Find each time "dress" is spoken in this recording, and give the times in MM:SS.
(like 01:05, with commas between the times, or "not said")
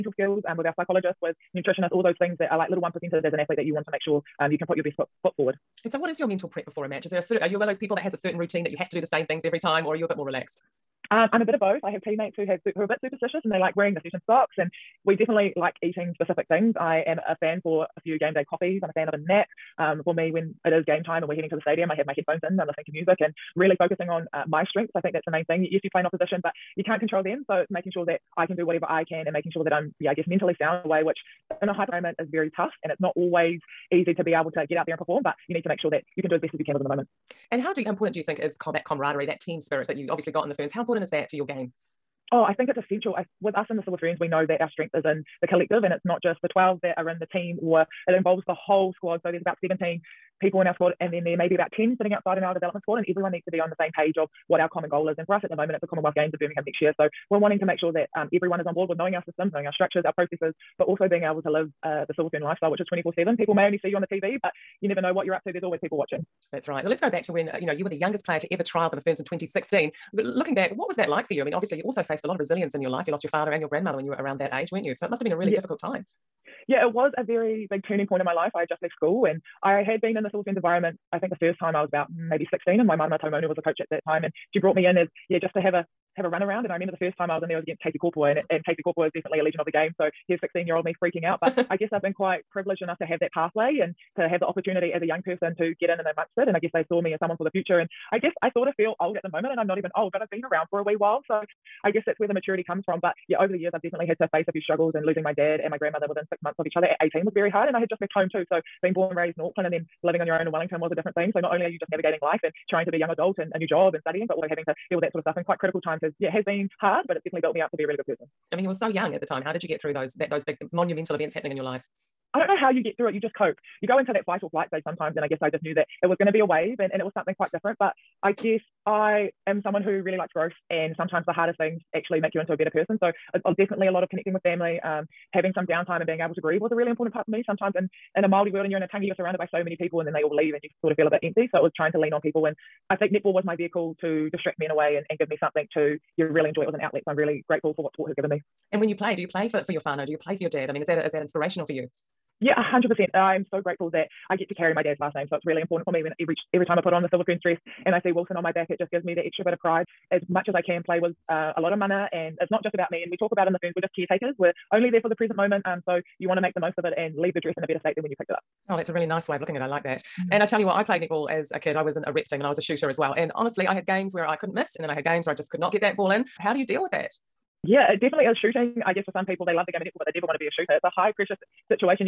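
02:37, 02:47.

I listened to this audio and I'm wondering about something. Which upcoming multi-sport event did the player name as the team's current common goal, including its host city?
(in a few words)
Commonwealth Games of Birmingham.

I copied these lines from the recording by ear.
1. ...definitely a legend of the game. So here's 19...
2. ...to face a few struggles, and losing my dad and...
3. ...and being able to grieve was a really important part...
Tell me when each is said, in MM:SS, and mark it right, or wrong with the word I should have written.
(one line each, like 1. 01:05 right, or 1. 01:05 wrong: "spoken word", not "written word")
1. 01:29 wrong: "16", not "19"
2. 01:44 right
3. 02:16 right.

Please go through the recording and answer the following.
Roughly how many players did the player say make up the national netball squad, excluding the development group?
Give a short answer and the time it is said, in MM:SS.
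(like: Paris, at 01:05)
17, at 00:49.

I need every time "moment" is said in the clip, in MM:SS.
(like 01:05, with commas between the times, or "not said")
00:31, 00:36, 00:55, 01:39, 02:45.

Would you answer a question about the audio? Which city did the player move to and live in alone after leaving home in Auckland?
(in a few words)
Wellington.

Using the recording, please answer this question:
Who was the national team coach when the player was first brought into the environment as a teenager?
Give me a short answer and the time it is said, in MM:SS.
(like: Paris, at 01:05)
Waimarama Taumaunu, at 01:22.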